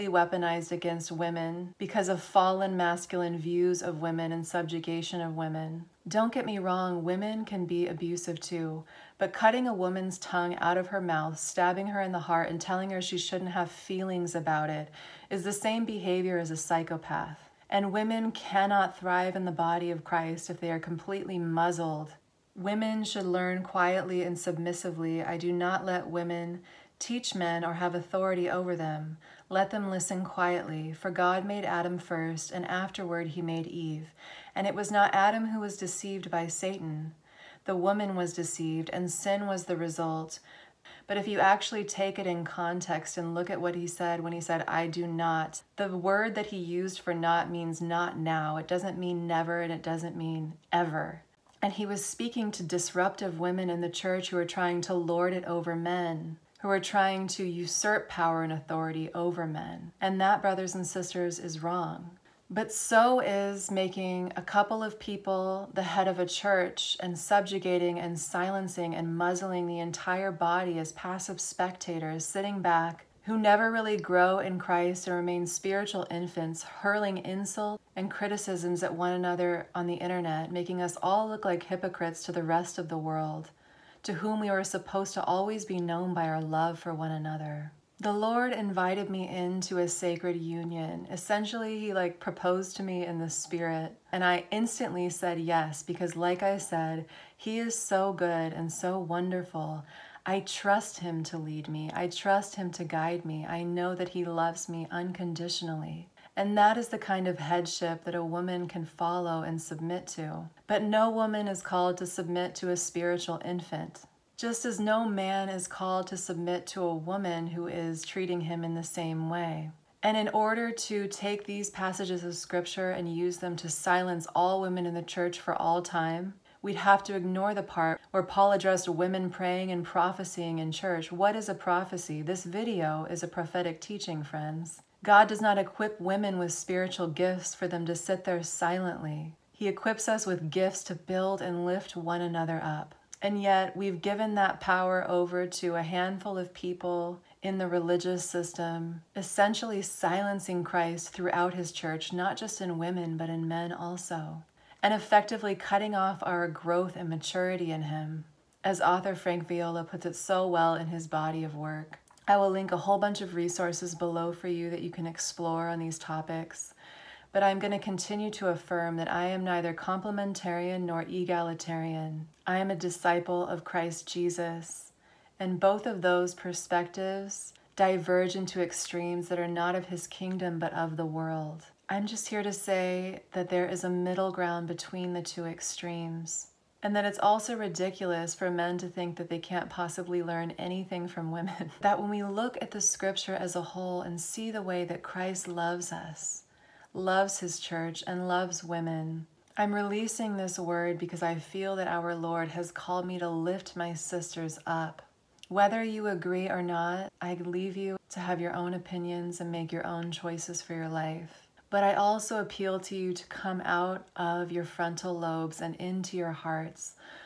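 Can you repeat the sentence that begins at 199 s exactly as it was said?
I'm releasing this word because I feel that our Lord has called me to lift my sisters up.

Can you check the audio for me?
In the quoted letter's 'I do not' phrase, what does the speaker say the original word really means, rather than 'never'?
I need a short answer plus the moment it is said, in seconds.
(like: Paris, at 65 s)
not now, at 47 s.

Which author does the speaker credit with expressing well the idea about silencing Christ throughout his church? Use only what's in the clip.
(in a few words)
Frank Viola.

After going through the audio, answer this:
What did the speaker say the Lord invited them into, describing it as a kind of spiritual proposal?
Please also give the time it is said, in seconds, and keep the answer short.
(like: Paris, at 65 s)
sacred union, at 89 s.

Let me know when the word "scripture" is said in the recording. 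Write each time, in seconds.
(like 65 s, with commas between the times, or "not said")
122 s, 192 s.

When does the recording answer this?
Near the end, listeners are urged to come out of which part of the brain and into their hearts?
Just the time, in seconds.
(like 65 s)
214 s.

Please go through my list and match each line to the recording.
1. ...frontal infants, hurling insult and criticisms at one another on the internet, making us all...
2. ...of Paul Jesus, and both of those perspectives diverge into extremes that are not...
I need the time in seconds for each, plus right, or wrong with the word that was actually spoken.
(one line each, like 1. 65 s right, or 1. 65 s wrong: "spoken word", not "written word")
1. 75 s wrong: "spiritual", not "frontal"
2. 173 s wrong: "Christ", not "Paul".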